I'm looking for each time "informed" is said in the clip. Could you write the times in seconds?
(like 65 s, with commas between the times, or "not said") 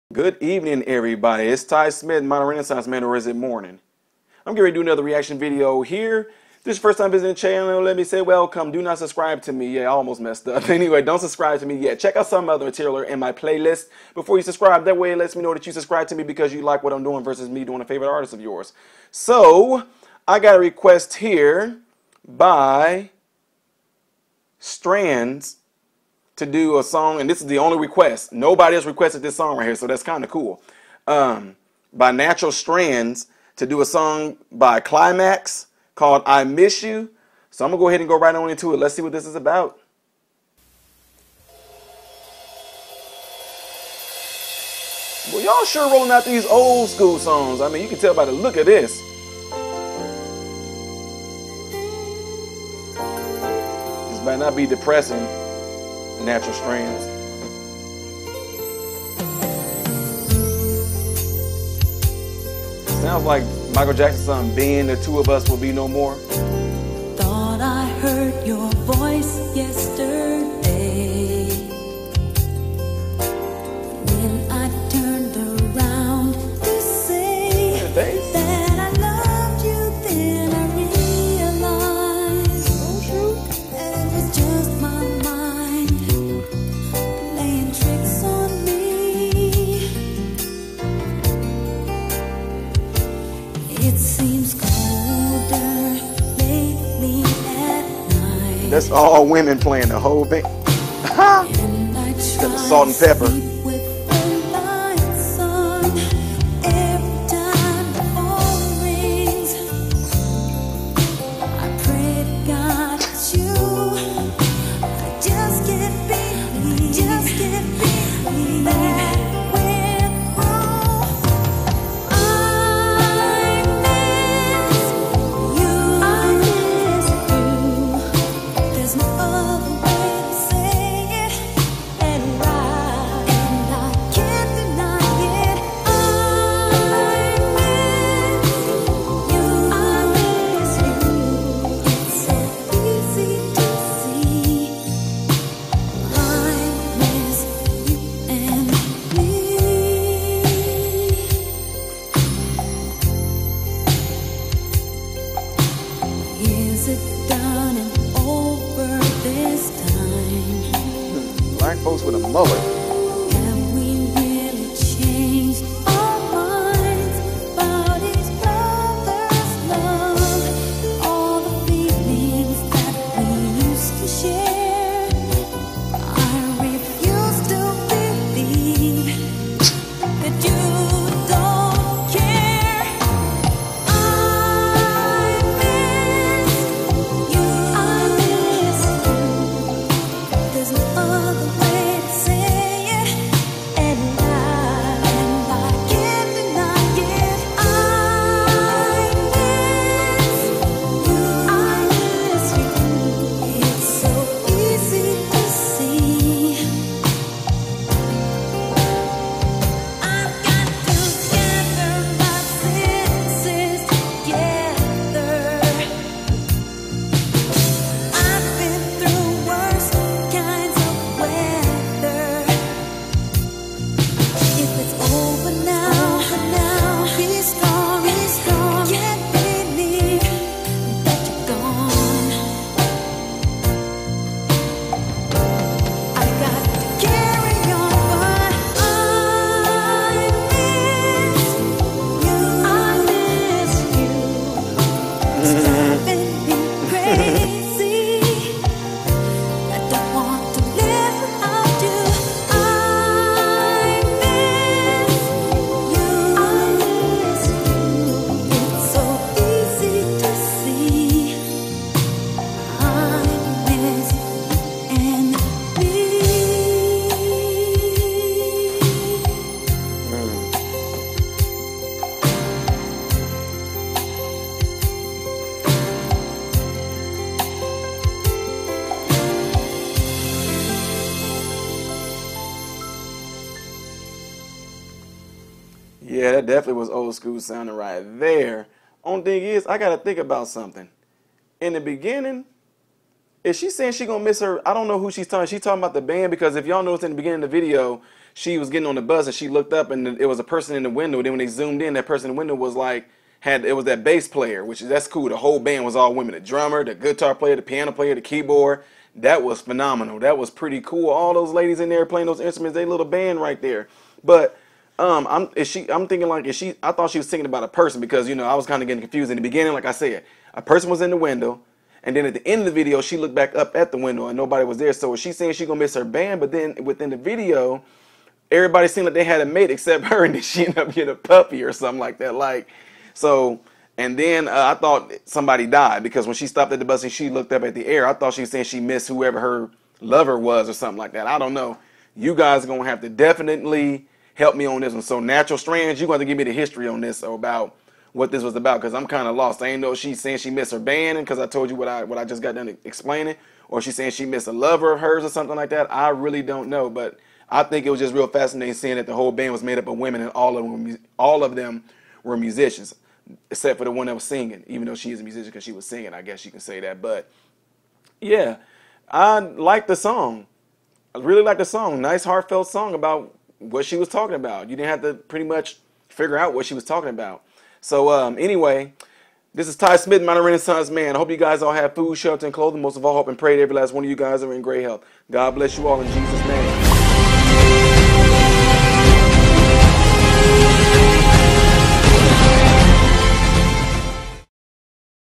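not said.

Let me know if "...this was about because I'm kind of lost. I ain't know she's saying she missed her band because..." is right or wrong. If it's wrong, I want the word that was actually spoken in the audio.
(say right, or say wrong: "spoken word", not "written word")
right.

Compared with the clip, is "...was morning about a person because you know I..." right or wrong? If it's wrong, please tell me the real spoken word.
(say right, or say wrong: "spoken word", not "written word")
wrong: "thinking", not "morning".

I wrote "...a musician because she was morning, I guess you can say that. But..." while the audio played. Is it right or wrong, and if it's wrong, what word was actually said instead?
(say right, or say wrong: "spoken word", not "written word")
wrong: "singing", not "morning".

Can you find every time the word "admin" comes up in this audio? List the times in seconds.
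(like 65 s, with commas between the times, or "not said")
not said.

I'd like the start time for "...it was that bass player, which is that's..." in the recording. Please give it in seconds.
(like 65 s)
303 s.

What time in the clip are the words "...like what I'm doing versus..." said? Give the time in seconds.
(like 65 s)
16 s.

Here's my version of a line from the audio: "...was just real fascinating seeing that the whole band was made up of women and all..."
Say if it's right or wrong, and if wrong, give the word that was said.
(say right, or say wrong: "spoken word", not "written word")
right.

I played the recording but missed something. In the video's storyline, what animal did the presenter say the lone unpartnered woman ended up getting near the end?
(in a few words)
A puppy.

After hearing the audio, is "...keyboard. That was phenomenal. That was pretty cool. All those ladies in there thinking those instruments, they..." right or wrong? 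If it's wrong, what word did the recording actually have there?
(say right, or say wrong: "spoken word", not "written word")
wrong: "playing", not "thinking".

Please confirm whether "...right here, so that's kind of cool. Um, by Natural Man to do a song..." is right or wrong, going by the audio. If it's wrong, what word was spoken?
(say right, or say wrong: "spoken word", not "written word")
wrong: "Strands", not "Man".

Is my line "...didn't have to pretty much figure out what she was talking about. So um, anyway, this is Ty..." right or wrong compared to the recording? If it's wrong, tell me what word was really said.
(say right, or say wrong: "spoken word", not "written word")
right.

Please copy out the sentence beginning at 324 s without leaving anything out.
So is she saying she gonna miss her band?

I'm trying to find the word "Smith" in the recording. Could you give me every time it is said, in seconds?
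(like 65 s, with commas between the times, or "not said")
1 s, 379 s.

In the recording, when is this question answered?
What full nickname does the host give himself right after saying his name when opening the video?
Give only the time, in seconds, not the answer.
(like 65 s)
2 s.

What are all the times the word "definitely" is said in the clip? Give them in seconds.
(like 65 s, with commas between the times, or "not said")
286 s, 343 s.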